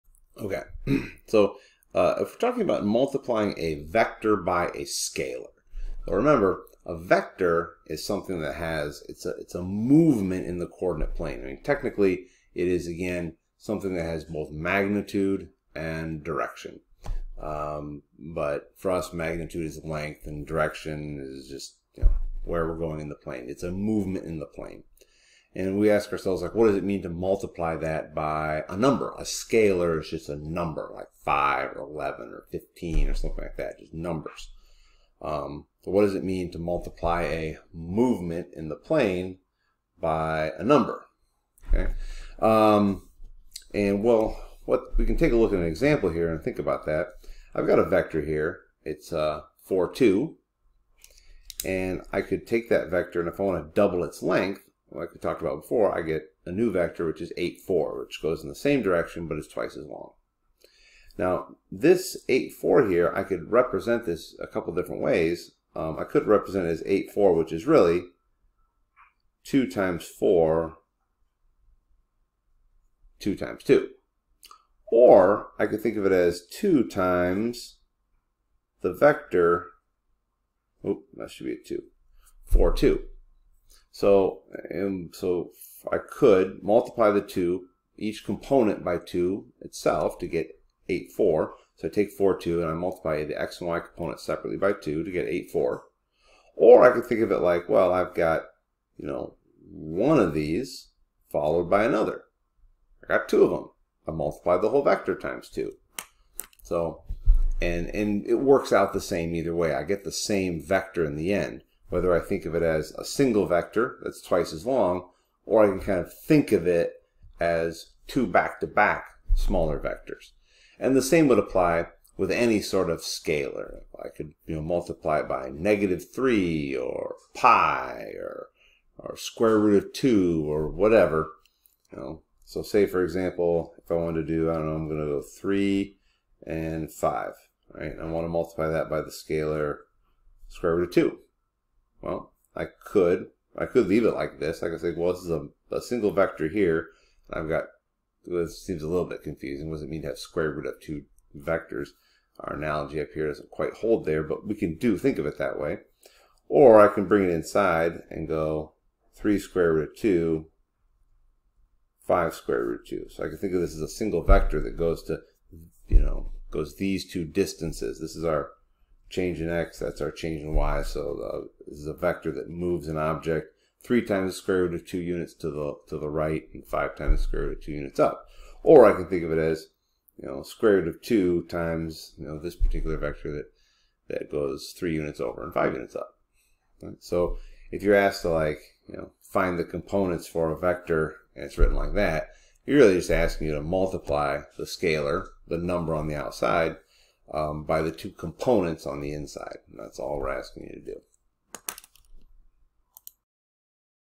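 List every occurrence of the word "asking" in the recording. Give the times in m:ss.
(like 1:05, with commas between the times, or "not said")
3:13, 3:20.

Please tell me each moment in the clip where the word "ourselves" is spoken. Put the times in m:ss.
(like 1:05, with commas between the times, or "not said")
0:26.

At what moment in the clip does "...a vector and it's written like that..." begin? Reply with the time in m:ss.
3:10.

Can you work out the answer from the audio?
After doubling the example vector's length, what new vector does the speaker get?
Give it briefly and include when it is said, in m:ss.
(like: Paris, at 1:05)
8, 4, at 0:57.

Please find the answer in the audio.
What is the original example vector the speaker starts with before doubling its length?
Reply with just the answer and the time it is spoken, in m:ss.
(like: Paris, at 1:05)
4, 2, at 0:48.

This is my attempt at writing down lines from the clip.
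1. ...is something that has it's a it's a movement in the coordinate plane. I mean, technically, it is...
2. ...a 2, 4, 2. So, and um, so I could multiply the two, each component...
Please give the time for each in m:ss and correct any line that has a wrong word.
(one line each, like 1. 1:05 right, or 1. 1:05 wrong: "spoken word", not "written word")
1. 0:07 right
2. 1:21 right.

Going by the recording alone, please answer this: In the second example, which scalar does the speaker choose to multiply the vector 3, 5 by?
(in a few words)
square root of 2.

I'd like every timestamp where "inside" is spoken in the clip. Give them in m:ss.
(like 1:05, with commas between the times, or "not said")
2:37, 3:19.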